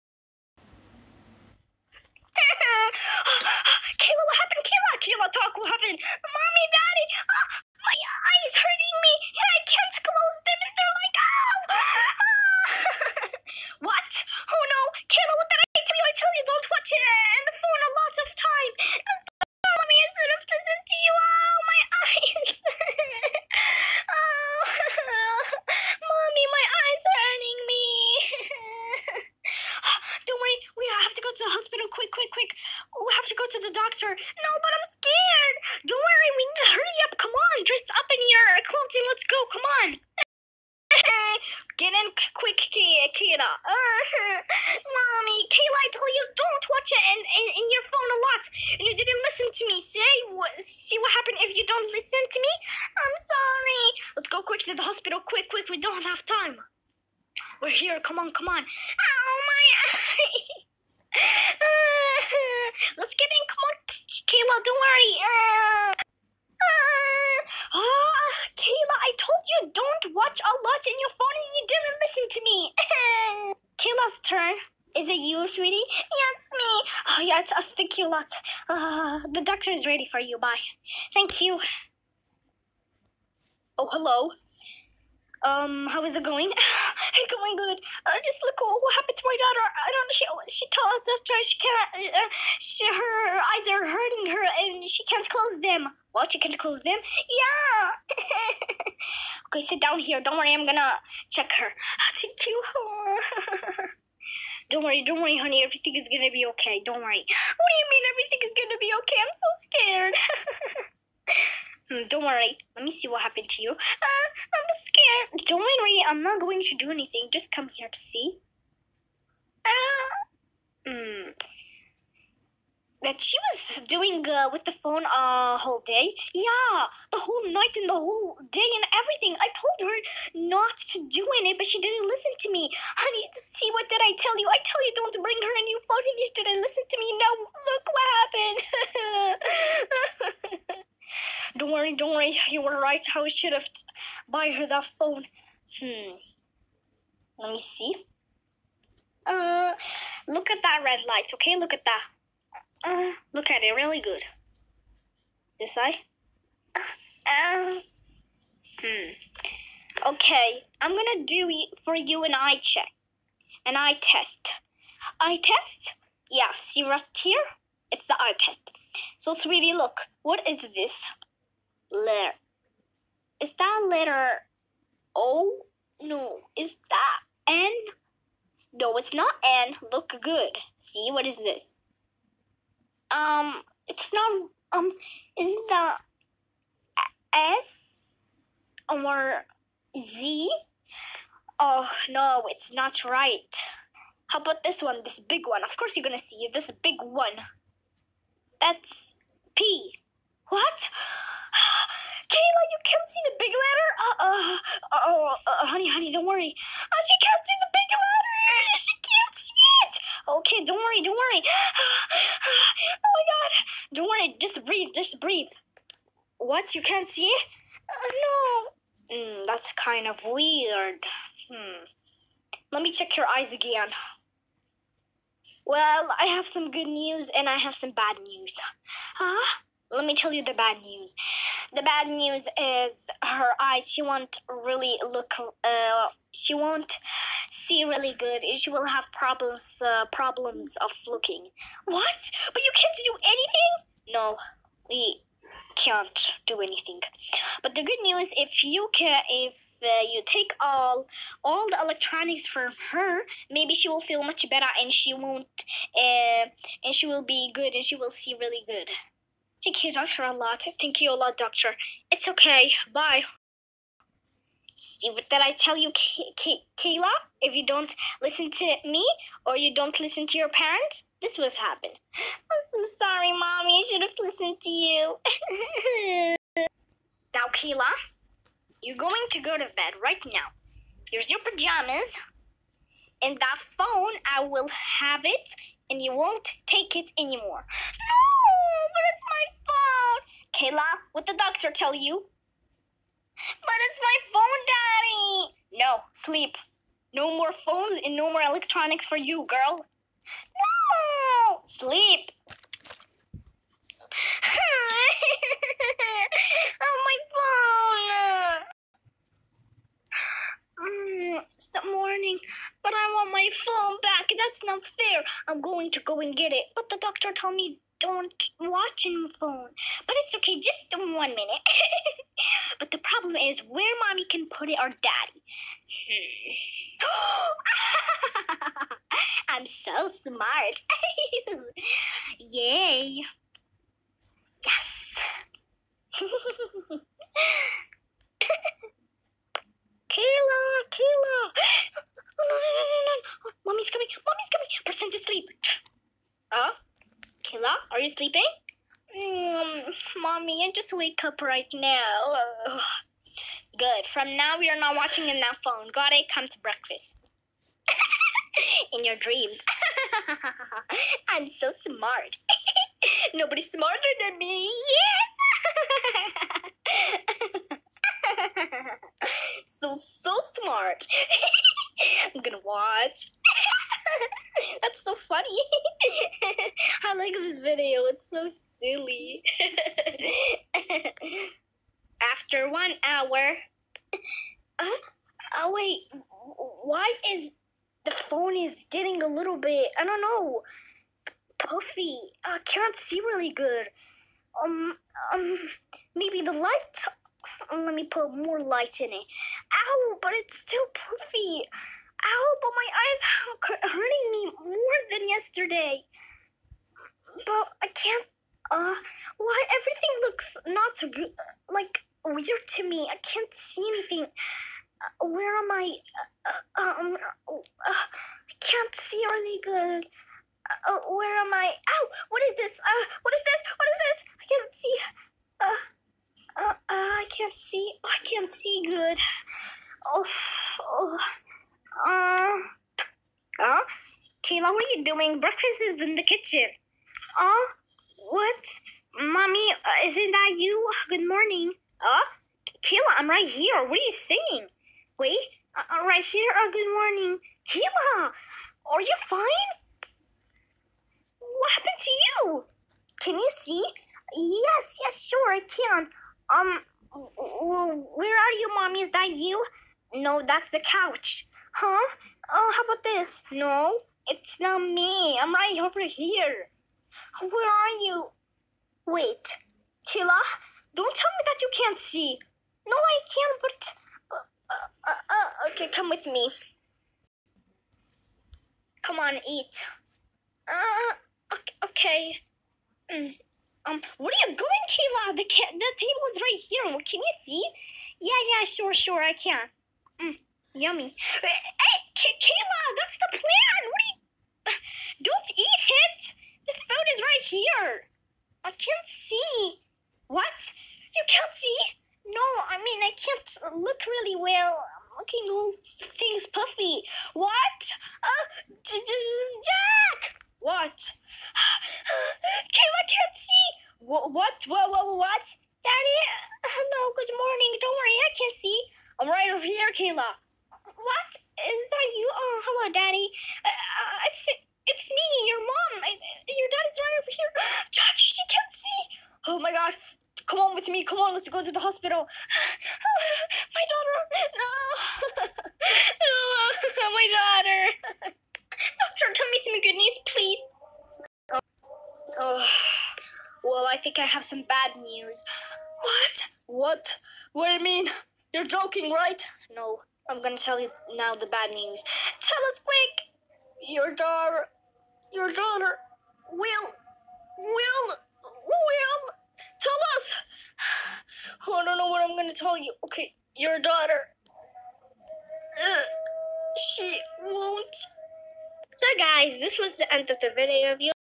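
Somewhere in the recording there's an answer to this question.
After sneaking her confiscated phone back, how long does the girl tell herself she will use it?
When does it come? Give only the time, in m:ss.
5:20.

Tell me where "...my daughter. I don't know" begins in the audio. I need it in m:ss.
1:29.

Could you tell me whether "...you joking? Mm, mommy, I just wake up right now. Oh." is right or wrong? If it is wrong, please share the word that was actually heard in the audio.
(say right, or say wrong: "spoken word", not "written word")
wrong: "sleeping", not "joking".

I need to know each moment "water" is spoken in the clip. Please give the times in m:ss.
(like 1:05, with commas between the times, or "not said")
not said.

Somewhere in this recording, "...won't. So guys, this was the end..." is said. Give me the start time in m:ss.
9:27.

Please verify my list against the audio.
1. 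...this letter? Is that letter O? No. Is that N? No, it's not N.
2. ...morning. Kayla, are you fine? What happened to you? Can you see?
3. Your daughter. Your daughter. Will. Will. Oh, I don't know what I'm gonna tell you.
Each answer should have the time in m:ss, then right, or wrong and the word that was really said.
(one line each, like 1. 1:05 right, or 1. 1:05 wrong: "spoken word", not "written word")
1. 2:50 right
2. 7:26 right
3. 9:13 right.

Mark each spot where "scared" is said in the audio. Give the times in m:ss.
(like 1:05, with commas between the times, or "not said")
1:49, 1:54.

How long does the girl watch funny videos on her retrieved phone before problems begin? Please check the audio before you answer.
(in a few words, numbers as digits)
1 hour.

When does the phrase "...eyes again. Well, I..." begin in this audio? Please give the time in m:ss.
3:43.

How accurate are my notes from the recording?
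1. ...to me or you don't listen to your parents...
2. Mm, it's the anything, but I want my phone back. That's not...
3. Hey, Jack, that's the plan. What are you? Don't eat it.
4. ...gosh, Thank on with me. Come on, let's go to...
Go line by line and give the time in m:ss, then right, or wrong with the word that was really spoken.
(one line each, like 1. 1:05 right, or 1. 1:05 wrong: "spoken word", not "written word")
1. 4:28 right
2. 5:10 wrong: "morning", not "anything"
3. 8:11 wrong: "Kayla", not "Jack"
4. 8:49 wrong: "Come", not "Thank".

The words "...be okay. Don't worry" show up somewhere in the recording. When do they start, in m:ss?
1:46.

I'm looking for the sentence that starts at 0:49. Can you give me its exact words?
See what, see what happened if you don't listen to me?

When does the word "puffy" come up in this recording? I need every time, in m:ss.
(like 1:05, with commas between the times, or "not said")
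6:31, 6:40, 8:26.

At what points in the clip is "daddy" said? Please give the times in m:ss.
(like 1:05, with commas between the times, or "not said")
4:54, 5:24, 8:35, 8:42.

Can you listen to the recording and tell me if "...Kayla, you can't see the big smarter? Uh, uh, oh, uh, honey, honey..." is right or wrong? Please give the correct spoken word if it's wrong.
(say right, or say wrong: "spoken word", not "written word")
wrong: "letter", not "smarter".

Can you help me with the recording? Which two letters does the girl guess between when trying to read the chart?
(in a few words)
S or Z.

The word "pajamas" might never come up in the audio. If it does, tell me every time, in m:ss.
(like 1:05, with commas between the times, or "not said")
4:41.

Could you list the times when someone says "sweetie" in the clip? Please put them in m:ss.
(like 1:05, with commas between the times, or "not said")
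1:15, 2:49.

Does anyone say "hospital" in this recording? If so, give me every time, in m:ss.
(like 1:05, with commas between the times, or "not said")
0:54, 8:51.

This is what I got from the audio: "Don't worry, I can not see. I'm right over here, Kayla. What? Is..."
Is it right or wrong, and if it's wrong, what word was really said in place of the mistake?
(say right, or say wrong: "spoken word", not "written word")
right.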